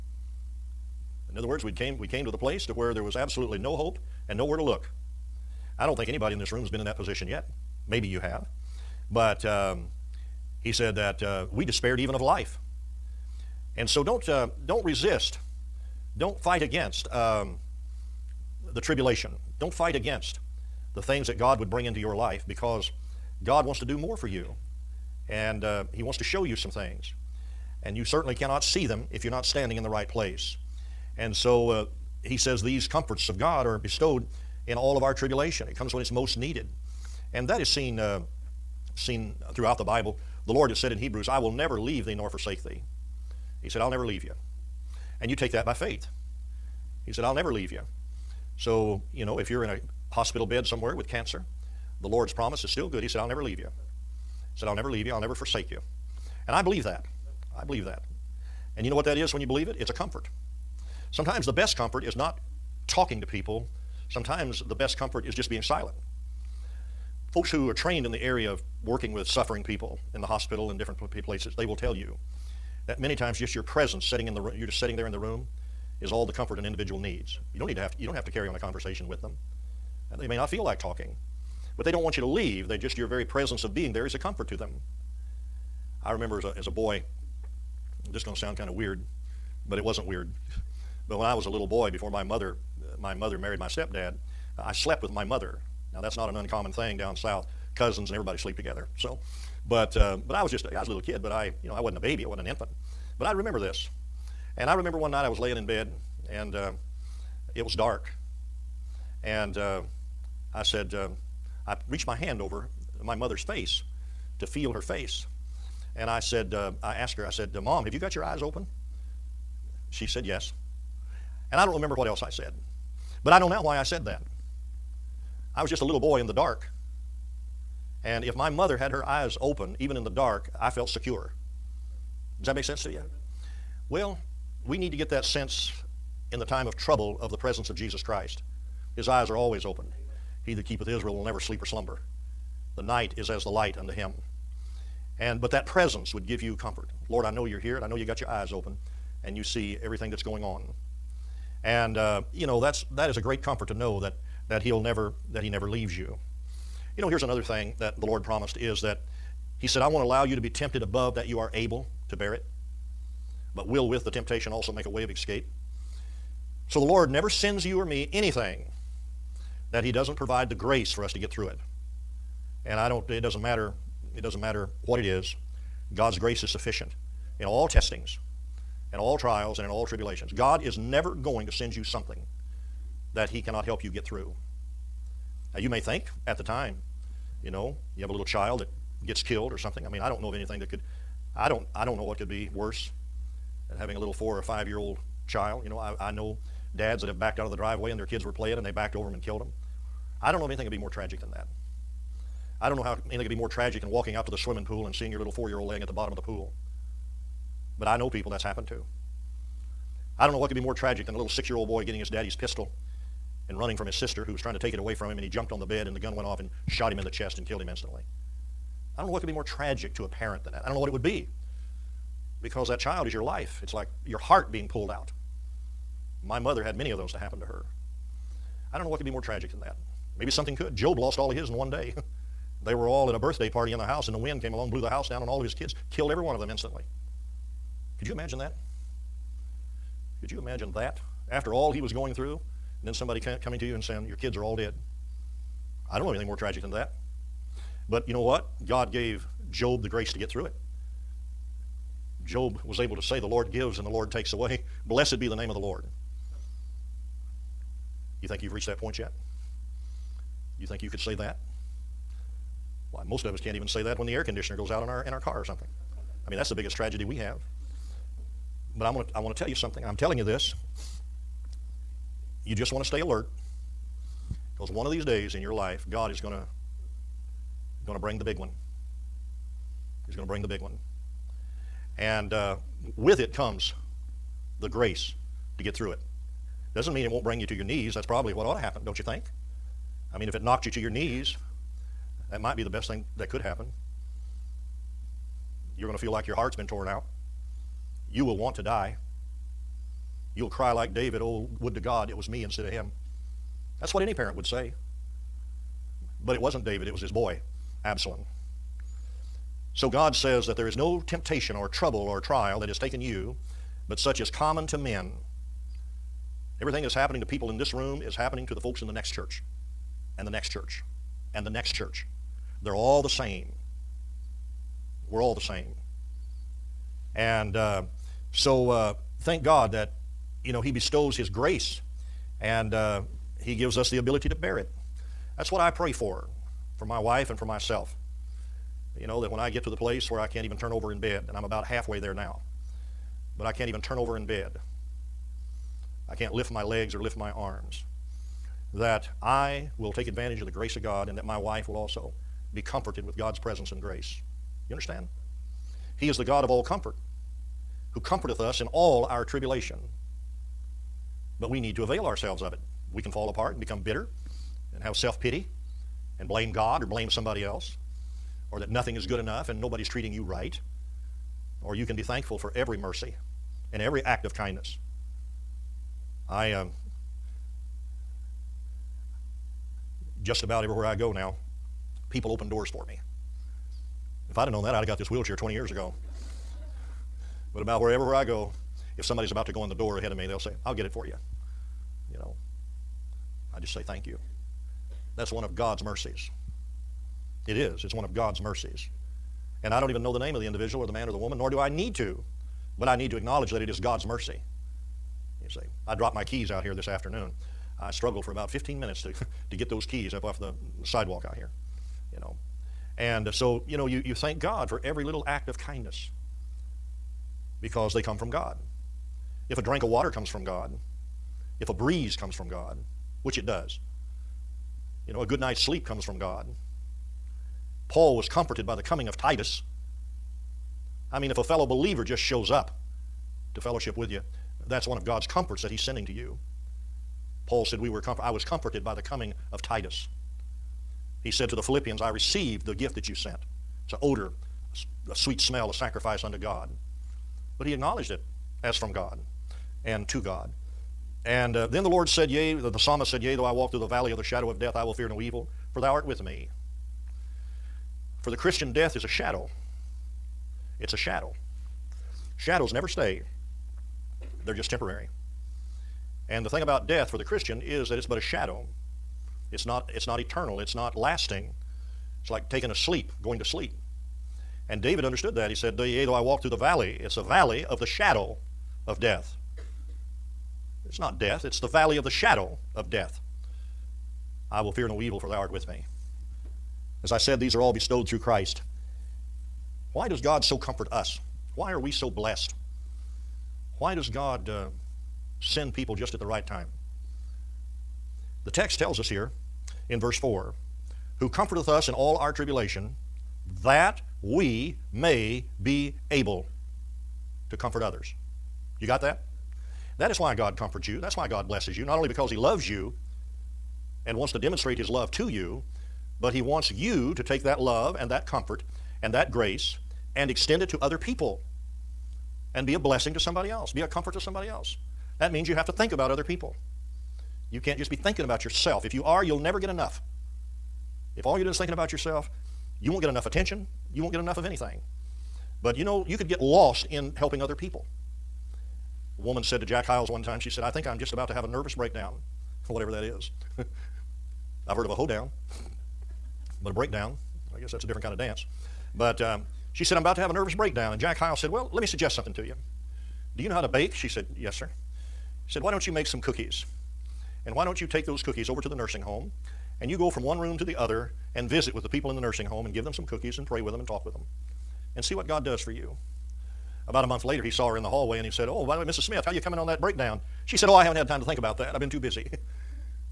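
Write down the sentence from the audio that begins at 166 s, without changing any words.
So the Lord never sends you or me anything that He doesn't provide the grace for us to get through it.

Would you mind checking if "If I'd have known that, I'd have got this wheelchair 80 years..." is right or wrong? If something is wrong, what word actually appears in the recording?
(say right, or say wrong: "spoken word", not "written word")
wrong: "20", not "80".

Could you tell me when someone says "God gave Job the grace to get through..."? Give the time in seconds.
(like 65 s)
248 s.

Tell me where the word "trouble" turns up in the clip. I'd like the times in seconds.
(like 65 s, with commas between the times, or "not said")
136 s, 311 s.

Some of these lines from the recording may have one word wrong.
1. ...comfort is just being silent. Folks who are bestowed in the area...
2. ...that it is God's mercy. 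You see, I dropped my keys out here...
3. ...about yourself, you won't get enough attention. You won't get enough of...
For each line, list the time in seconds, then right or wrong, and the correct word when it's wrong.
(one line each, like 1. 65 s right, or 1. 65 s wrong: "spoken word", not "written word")
1. 64 s wrong: "trained", not "bestowed"
2. 403 s right
3. 531 s right.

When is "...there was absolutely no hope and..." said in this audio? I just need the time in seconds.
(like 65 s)
2 s.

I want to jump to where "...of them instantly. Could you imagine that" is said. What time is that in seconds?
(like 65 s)
236 s.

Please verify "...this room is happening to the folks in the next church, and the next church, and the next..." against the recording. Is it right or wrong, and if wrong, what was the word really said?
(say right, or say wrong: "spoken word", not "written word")
right.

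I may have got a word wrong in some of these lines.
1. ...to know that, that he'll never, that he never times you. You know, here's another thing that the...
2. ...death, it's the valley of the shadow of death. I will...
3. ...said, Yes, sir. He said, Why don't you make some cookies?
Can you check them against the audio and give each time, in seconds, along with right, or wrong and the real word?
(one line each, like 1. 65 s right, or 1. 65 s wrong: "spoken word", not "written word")
1. 153 s wrong: "leaves", not "times"
2. 481 s right
3. 554 s right.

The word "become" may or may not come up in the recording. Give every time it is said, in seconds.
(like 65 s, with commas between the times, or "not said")
363 s.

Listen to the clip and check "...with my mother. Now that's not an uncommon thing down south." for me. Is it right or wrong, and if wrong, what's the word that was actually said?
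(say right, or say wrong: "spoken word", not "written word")
right.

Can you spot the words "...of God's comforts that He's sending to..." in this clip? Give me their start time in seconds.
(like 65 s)
434 s.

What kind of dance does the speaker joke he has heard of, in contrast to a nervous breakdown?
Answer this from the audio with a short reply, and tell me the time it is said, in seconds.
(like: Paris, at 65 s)
A hoedown, at 544 s.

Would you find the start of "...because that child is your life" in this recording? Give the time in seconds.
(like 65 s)
222 s.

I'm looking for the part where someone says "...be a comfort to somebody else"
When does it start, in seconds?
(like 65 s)
523 s.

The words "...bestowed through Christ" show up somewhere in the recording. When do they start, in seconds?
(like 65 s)
487 s.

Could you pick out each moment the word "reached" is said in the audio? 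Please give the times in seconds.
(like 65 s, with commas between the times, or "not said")
111 s, 258 s.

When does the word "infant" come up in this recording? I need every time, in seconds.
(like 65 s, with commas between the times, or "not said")
102 s.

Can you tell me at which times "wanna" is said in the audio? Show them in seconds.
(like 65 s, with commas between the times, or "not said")
not said.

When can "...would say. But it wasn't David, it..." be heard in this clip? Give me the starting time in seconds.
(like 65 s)
304 s.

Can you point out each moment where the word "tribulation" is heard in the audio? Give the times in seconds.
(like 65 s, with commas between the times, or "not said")
18 s, 35 s, 179 s, 359 s, 502 s.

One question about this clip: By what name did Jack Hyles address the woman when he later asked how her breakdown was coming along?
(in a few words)
Mrs. Smith.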